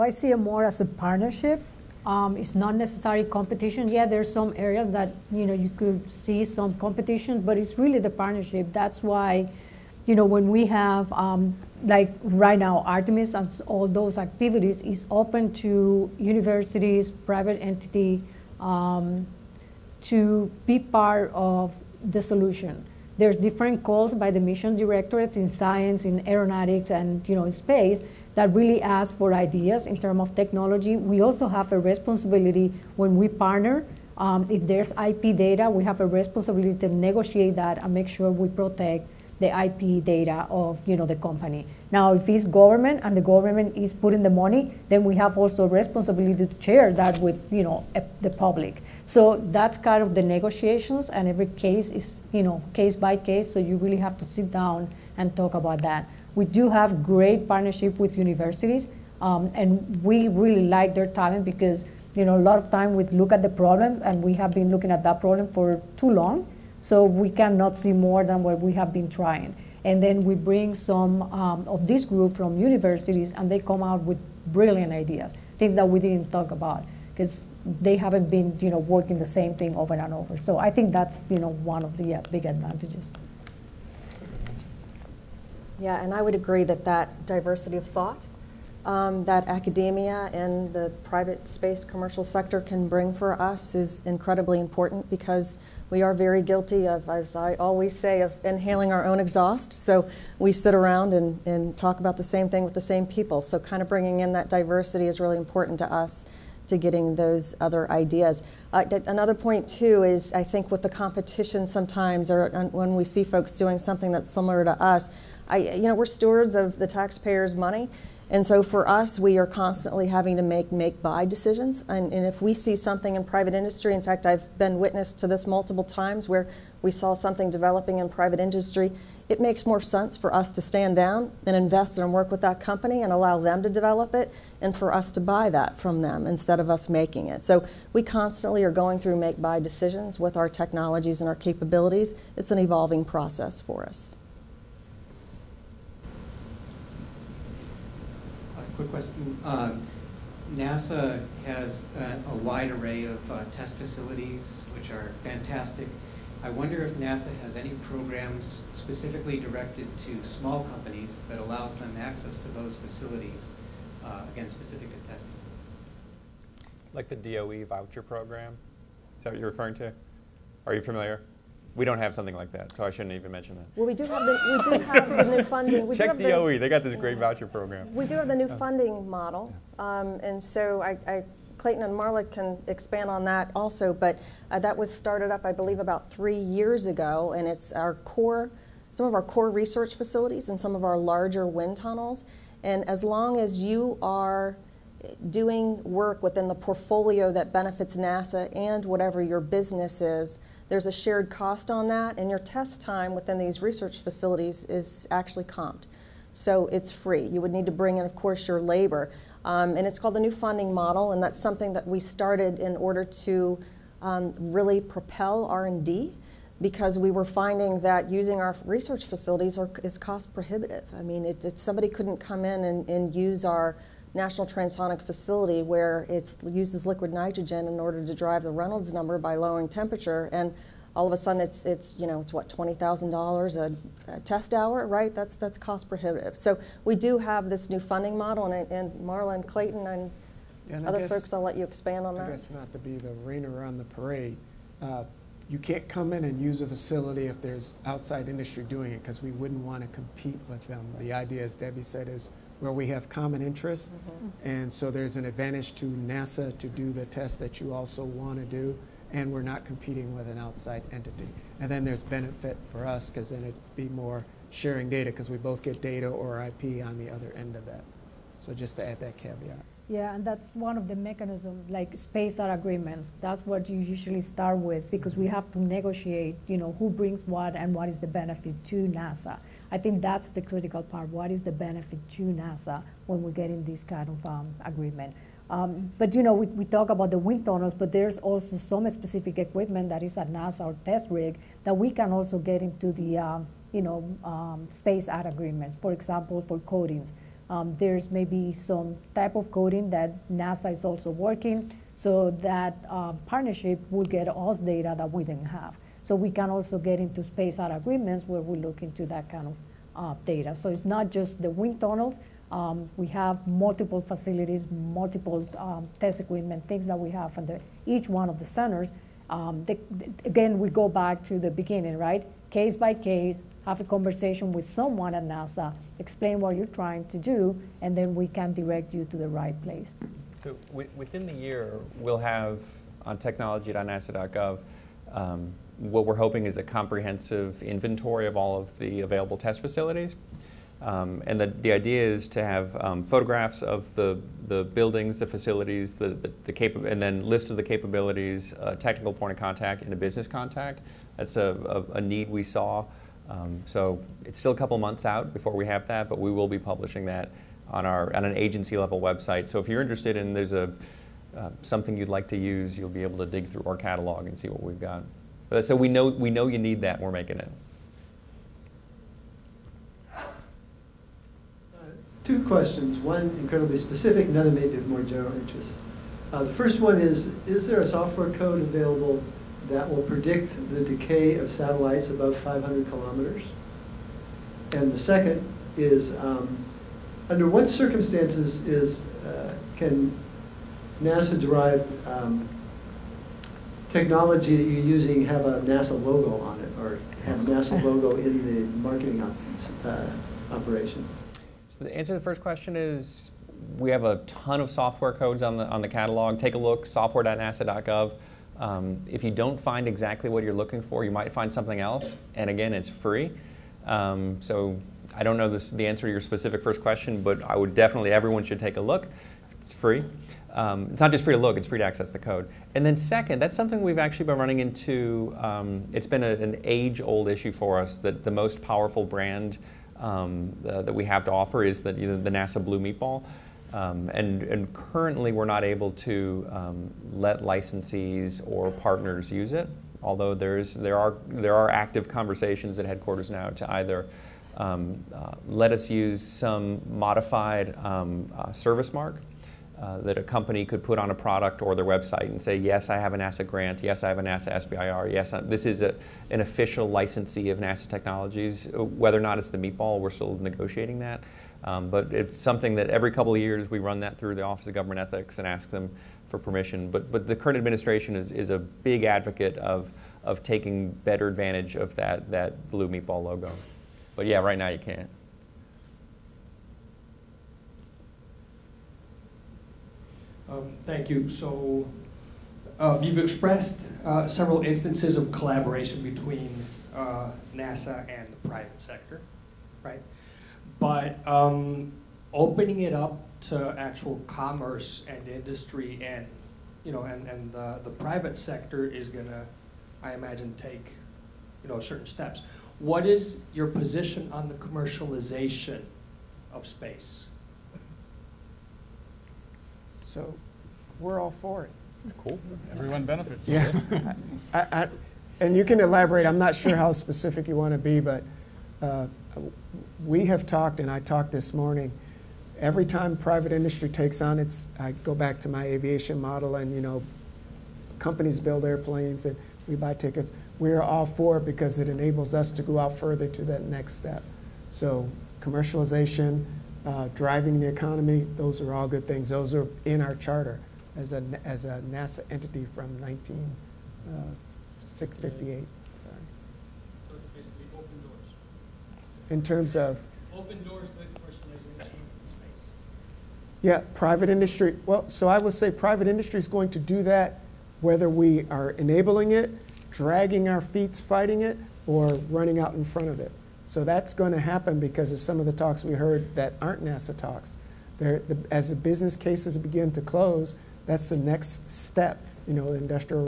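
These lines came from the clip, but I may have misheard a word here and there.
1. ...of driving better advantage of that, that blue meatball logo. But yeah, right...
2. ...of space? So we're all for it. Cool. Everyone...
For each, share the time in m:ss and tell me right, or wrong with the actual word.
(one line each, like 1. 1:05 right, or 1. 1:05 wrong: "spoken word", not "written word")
1. 7:50 wrong: "taking", not "driving"
2. 8:26 right.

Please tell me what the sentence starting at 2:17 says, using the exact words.
So we constantly are going through make buy decisions with our technologies and our capabilities.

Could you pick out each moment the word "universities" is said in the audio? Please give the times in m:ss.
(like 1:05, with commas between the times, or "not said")
0:16, 0:58, 1:12.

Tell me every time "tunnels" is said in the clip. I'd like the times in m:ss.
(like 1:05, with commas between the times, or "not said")
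3:11, 4:47, 5:11.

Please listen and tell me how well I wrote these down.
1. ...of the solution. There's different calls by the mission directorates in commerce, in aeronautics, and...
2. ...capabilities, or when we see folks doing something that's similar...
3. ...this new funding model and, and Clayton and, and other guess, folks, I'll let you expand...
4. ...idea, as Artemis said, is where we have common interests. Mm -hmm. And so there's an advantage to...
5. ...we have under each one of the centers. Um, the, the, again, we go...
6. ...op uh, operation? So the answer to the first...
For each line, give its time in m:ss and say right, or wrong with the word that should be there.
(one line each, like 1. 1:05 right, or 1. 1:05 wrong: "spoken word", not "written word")
1. 0:21 wrong: "science", not "commerce"
2. 1:51 wrong: "sometimes", not "capabilities"
3. 3:57 right
4. 4:11 wrong: "Debbie", not "Artemis"
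5. 5:16 right
6. 6:39 right.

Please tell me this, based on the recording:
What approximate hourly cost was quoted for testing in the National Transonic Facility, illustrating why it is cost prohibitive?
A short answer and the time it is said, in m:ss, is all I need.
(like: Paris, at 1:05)
$20,000, at 3:52.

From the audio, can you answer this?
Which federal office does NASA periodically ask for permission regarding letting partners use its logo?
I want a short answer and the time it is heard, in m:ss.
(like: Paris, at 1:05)
Office of Government Ethics, at 7:44.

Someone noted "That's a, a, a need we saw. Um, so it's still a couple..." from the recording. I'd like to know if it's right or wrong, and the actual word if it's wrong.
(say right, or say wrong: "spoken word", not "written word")
right.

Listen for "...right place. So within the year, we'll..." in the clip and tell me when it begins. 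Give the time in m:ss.
5:29.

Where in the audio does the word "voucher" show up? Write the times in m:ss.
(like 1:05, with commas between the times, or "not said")
2:47, 2:57.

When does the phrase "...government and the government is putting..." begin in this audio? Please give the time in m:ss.
0:42.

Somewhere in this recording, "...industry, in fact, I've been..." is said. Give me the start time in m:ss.
2:03.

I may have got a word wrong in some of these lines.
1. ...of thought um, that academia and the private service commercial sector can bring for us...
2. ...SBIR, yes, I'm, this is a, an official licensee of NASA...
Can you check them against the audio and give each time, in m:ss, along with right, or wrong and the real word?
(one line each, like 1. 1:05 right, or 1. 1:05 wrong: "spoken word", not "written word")
1. 1:27 wrong: "space", not "service"
2. 7:34 right.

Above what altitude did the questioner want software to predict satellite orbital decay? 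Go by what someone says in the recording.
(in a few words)
500 kilometers.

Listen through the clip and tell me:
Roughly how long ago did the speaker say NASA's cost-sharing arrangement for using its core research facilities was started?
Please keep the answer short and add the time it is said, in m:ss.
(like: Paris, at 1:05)
about 3 years ago, at 3:05.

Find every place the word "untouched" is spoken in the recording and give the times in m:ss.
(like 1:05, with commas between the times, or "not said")
not said.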